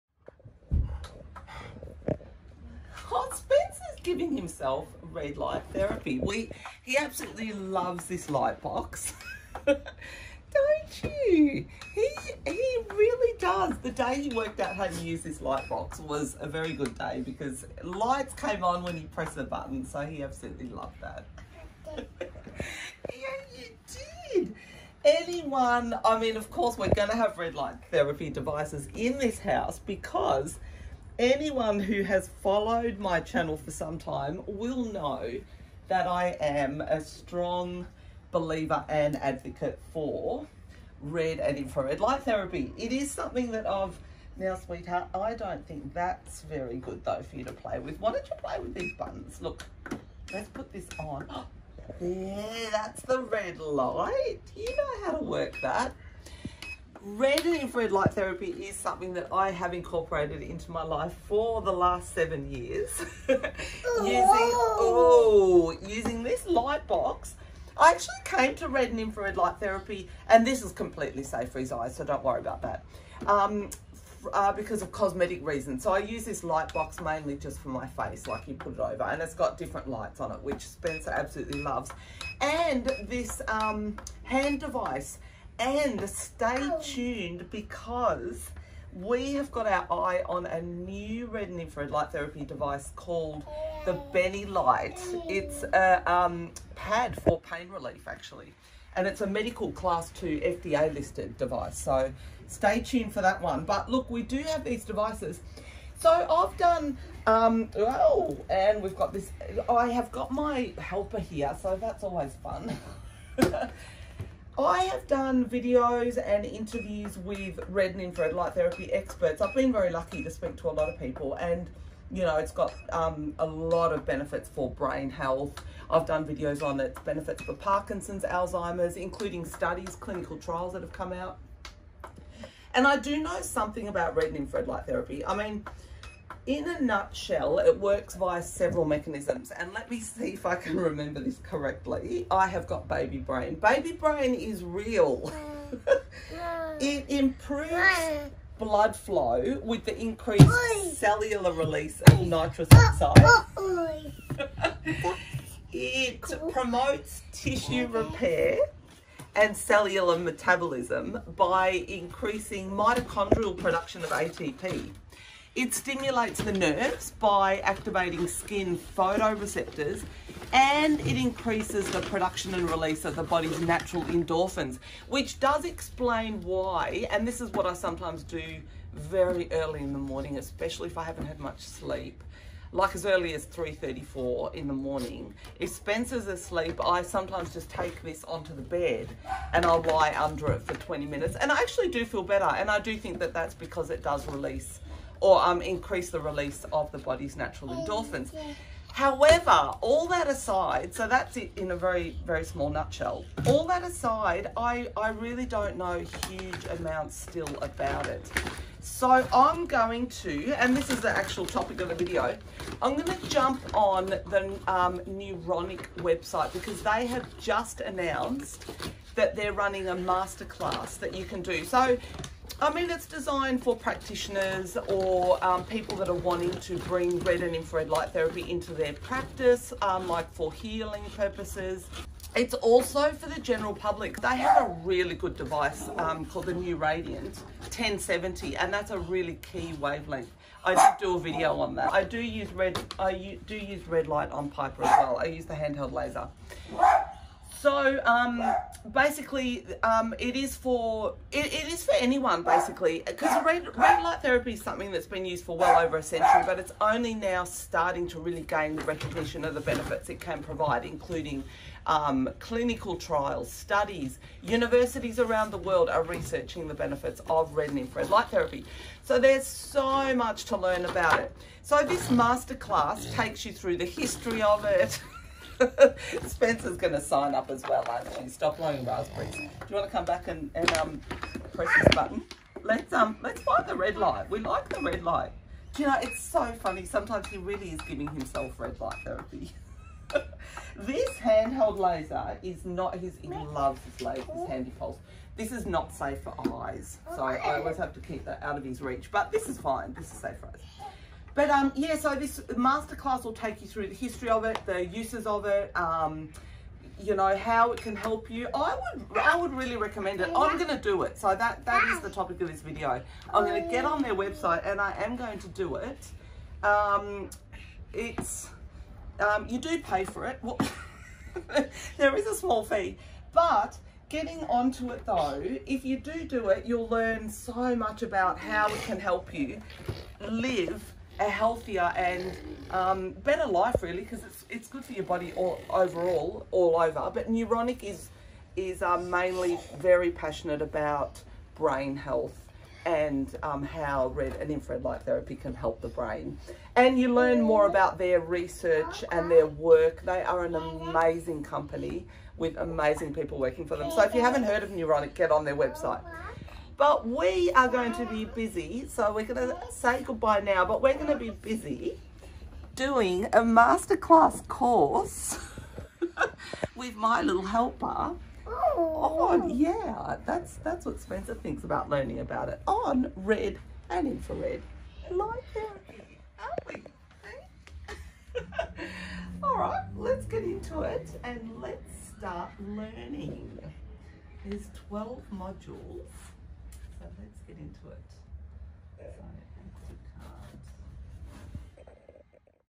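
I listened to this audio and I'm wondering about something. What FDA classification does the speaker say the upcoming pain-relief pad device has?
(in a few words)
Class 2.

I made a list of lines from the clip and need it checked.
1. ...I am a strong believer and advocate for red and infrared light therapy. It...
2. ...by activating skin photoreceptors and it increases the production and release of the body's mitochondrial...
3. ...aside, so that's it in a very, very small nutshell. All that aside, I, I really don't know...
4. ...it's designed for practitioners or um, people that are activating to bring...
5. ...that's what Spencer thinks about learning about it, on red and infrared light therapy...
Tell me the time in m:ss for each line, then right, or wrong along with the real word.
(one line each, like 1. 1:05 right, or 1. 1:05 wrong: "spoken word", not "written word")
1. 0:36 right
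2. 2:47 wrong: "natural", not "mitochondrial"
3. 3:20 right
4. 3:42 wrong: "wanting", not "activating"
5. 6:10 right.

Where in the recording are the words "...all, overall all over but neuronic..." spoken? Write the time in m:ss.
5:35.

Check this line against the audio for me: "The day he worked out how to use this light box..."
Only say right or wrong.
right.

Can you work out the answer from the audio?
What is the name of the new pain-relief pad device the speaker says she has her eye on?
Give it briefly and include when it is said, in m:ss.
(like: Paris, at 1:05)
Benilight, at 1:34.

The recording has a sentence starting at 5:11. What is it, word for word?
So that that is the topic of this video.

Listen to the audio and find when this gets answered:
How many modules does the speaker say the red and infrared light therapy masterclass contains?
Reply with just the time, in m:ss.
6:24.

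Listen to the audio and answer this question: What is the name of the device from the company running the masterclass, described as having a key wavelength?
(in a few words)
Neuradiant 1070.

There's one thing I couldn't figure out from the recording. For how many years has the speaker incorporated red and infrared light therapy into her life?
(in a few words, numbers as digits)
7.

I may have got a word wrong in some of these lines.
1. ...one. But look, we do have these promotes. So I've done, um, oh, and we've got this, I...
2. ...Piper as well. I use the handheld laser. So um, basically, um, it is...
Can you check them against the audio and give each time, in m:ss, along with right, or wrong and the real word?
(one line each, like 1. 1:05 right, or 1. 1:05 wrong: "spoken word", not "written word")
1. 1:43 wrong: "devices", not "promotes"
2. 4:04 right.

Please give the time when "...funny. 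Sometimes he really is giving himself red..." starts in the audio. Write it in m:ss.
4:46.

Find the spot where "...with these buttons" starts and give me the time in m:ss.
0:48.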